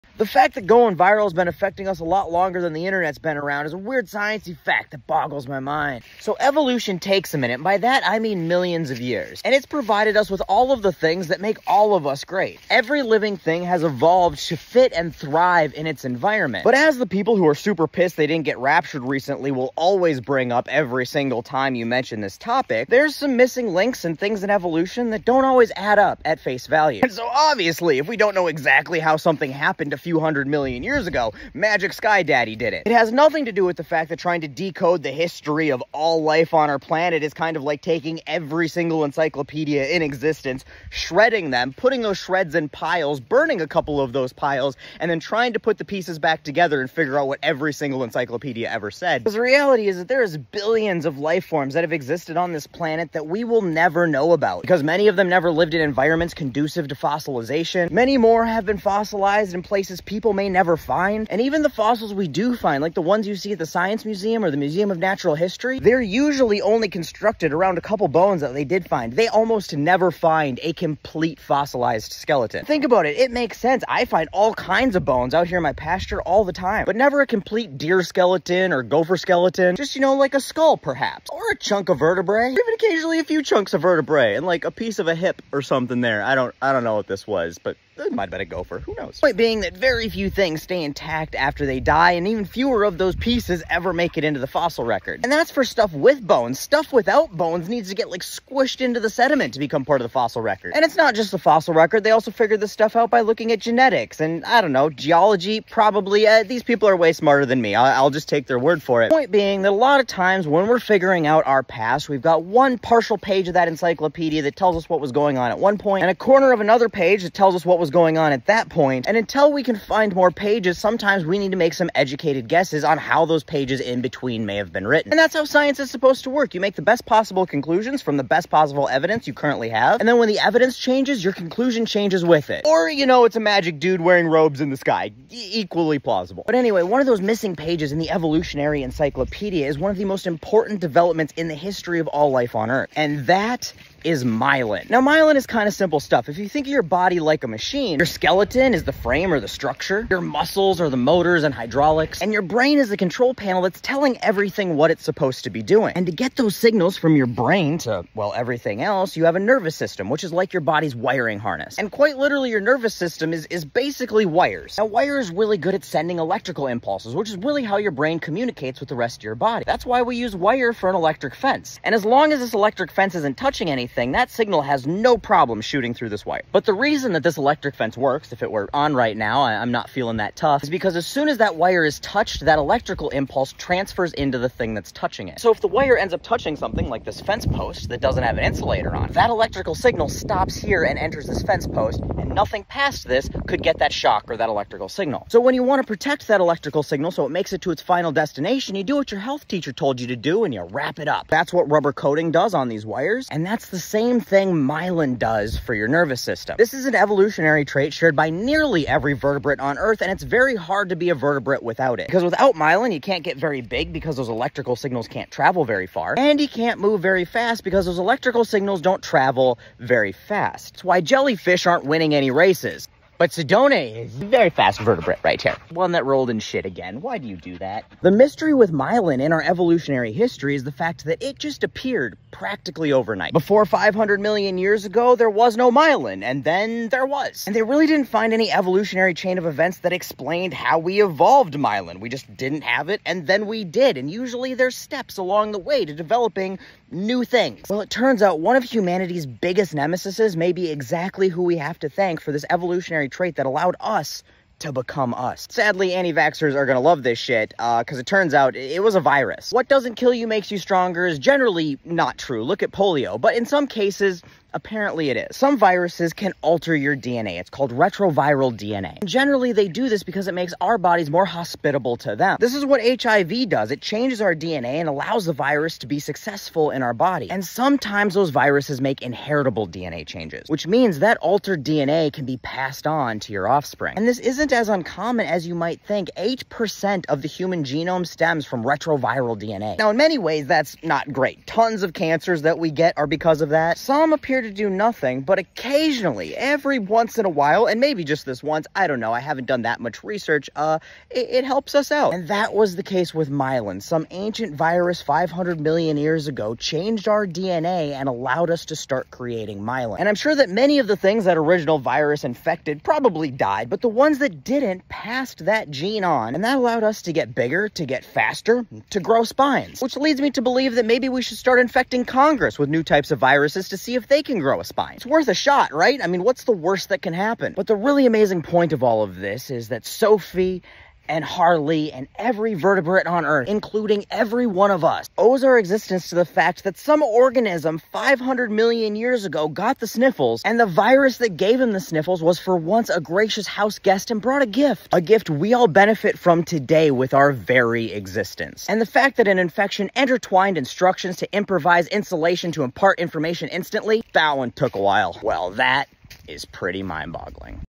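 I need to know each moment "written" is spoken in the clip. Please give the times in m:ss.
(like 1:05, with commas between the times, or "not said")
2:04.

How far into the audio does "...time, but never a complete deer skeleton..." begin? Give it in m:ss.
1:16.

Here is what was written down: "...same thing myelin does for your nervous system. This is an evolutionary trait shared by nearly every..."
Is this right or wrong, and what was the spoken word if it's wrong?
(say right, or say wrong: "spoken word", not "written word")
right.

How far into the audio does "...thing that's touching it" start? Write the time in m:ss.
3:04.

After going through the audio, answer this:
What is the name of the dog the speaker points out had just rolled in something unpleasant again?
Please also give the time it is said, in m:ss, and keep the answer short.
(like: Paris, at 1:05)
Sedona, at 3:43.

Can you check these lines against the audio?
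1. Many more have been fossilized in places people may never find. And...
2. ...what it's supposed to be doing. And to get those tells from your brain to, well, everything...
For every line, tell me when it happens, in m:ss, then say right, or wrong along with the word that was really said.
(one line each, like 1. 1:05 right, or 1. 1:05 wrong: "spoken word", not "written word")
1. 0:57 right
2. 2:34 wrong: "signals", not "tells".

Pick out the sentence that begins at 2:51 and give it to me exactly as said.
And as long as this electric fence isn't touching anything, anything, that signal has no problem shooting through this wire.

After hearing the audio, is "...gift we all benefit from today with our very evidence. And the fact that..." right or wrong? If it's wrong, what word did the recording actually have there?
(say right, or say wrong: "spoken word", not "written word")
wrong: "existence", not "evidence".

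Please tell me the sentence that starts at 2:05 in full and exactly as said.
And that's how science is supposed to work.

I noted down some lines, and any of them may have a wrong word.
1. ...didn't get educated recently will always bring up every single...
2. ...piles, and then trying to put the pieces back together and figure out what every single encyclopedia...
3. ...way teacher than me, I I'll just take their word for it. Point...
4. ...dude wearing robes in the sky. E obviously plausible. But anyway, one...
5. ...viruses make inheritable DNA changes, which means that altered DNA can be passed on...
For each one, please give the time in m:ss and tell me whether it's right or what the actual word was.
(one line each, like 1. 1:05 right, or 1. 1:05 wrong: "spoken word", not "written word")
1. 0:18 wrong: "raptured", not "educated"
2. 0:44 right
3. 1:46 wrong: "smarter", not "teacher"
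4. 2:13 wrong: "equally", not "obviously"
5. 4:38 right.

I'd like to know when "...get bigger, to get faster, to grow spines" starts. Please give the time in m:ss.
5:17.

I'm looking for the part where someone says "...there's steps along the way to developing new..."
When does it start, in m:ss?
4:04.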